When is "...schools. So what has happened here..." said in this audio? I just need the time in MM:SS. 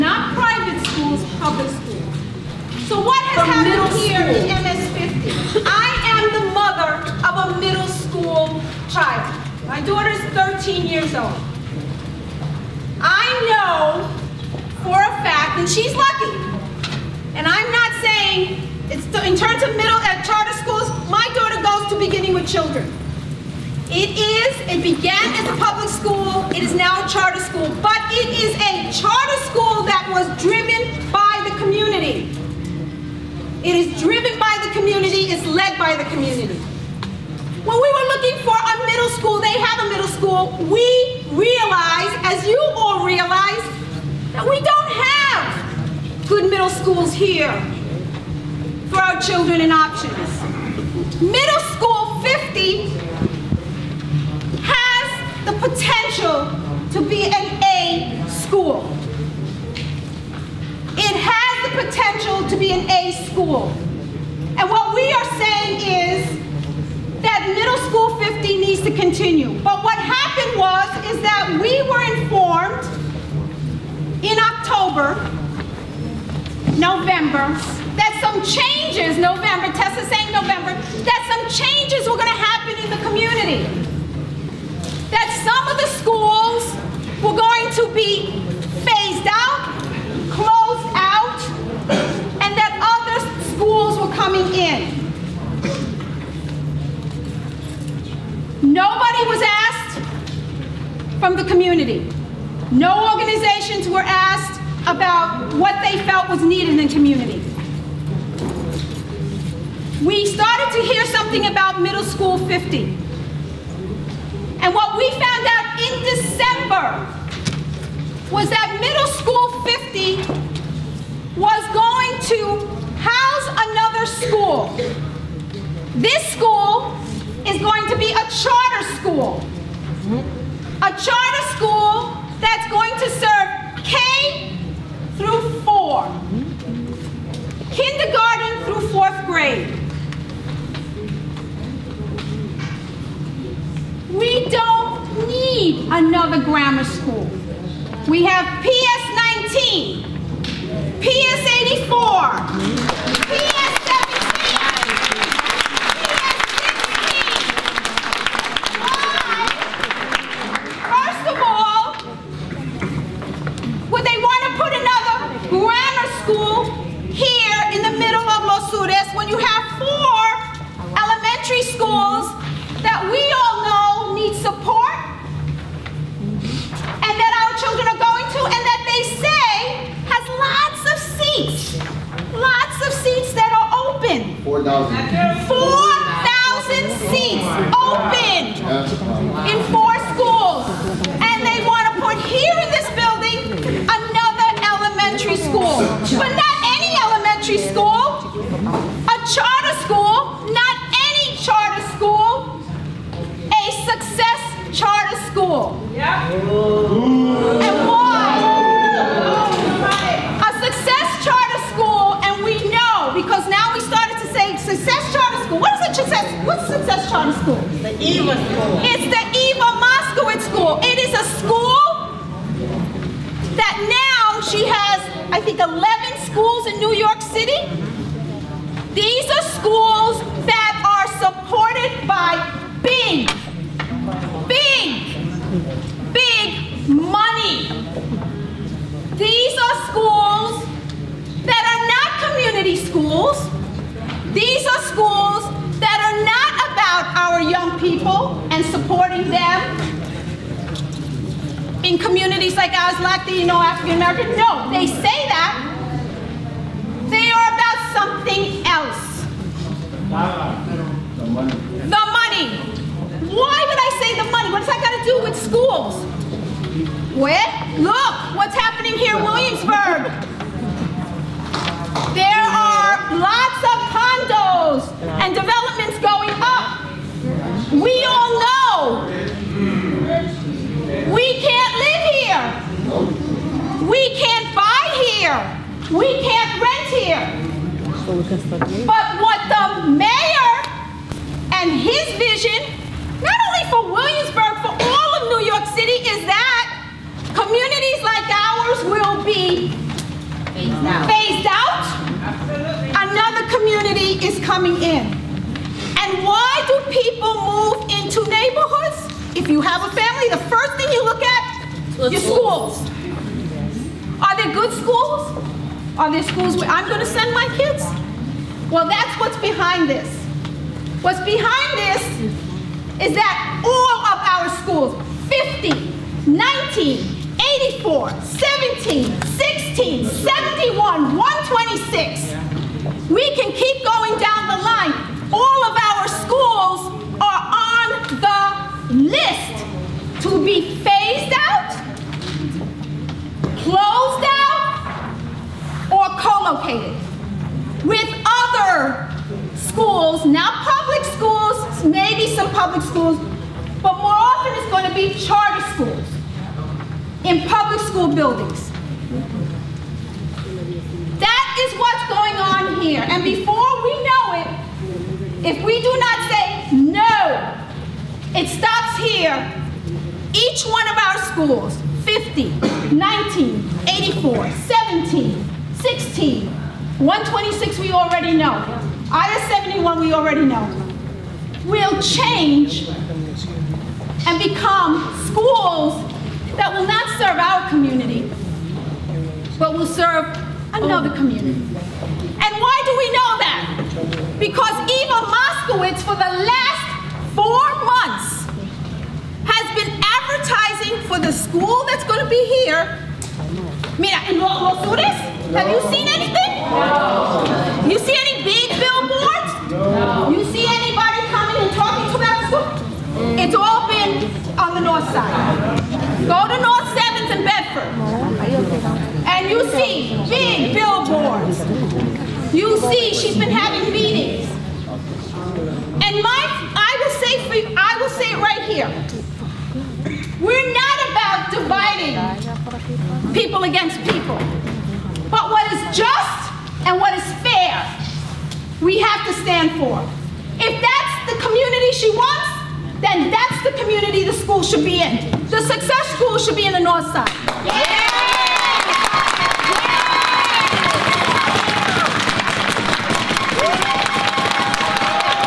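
00:01.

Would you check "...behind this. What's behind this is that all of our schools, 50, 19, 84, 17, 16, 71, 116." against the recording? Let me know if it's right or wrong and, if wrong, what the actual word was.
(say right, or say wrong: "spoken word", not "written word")
wrong: "126", not "116".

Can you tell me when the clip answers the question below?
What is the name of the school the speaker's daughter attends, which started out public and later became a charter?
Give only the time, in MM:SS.
00:21.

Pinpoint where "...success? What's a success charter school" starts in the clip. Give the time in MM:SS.
03:35.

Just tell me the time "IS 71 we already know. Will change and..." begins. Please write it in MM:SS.
06:19.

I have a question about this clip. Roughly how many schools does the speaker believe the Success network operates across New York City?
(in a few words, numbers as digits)
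11.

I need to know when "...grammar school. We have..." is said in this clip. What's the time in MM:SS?
02:26.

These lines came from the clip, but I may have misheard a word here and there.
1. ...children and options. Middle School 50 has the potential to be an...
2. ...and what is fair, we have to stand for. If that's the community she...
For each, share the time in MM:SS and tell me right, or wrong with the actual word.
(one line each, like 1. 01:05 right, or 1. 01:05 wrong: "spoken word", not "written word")
1. 00:49 right
2. 07:16 right.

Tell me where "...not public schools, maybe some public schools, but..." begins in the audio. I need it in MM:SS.
05:50.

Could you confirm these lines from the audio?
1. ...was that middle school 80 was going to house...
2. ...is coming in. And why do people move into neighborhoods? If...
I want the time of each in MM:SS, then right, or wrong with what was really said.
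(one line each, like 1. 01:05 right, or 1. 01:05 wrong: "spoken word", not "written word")
1. 01:58 wrong: "50", not "80"
2. 05:04 right.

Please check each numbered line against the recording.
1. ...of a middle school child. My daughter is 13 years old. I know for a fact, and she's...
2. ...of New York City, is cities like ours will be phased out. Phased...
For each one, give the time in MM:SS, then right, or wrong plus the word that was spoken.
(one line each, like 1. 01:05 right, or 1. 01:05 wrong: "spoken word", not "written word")
1. 00:07 right
2. 04:55 right.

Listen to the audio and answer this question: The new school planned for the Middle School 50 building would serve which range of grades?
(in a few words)
K through 4.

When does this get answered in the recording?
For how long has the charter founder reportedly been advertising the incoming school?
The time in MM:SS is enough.
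06:37.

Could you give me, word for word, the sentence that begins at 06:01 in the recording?
That is what's going on here.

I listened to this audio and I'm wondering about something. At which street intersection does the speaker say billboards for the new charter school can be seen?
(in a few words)
North 7th and Bedford.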